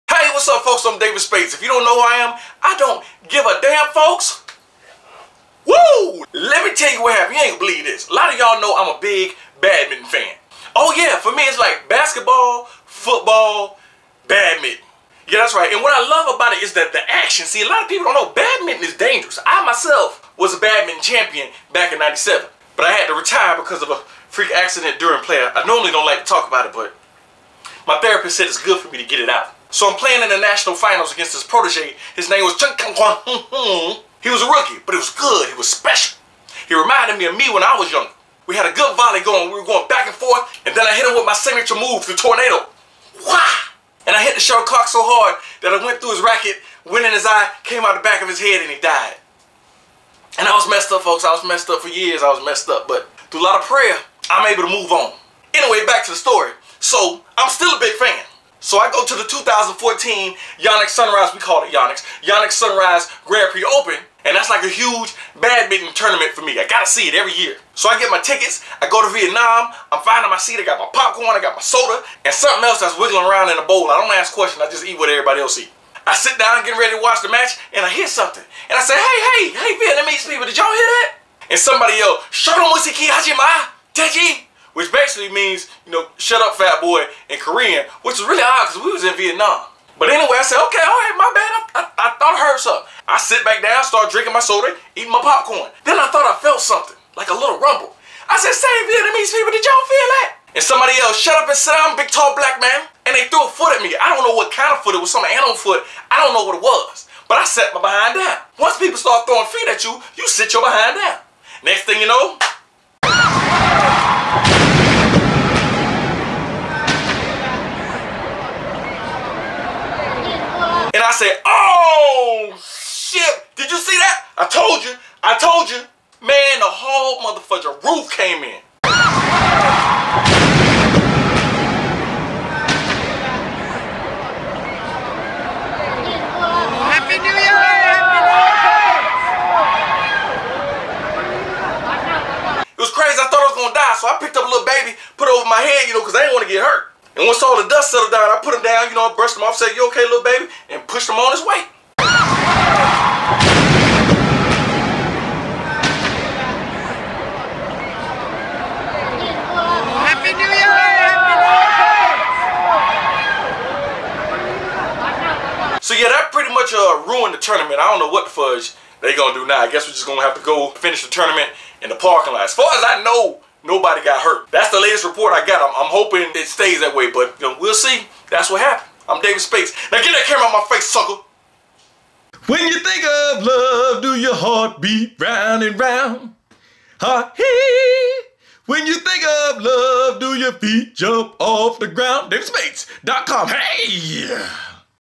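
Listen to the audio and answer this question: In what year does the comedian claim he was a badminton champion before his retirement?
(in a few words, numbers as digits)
1997.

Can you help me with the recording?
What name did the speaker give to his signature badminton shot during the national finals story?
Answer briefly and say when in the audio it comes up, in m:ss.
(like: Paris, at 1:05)
the tornado, at 0:42.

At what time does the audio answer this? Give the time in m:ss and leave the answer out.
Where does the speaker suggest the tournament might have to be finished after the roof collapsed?
2:51.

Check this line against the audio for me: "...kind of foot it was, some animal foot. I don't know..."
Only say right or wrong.
right.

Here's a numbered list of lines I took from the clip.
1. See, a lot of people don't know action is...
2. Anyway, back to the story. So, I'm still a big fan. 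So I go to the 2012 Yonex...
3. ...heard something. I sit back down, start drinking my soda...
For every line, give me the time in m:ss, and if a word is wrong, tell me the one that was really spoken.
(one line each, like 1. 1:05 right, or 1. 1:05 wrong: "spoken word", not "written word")
1. 0:17 wrong: "badminton", not "action"
2. 0:55 wrong: "2014", not "2012"
3. 1:32 right.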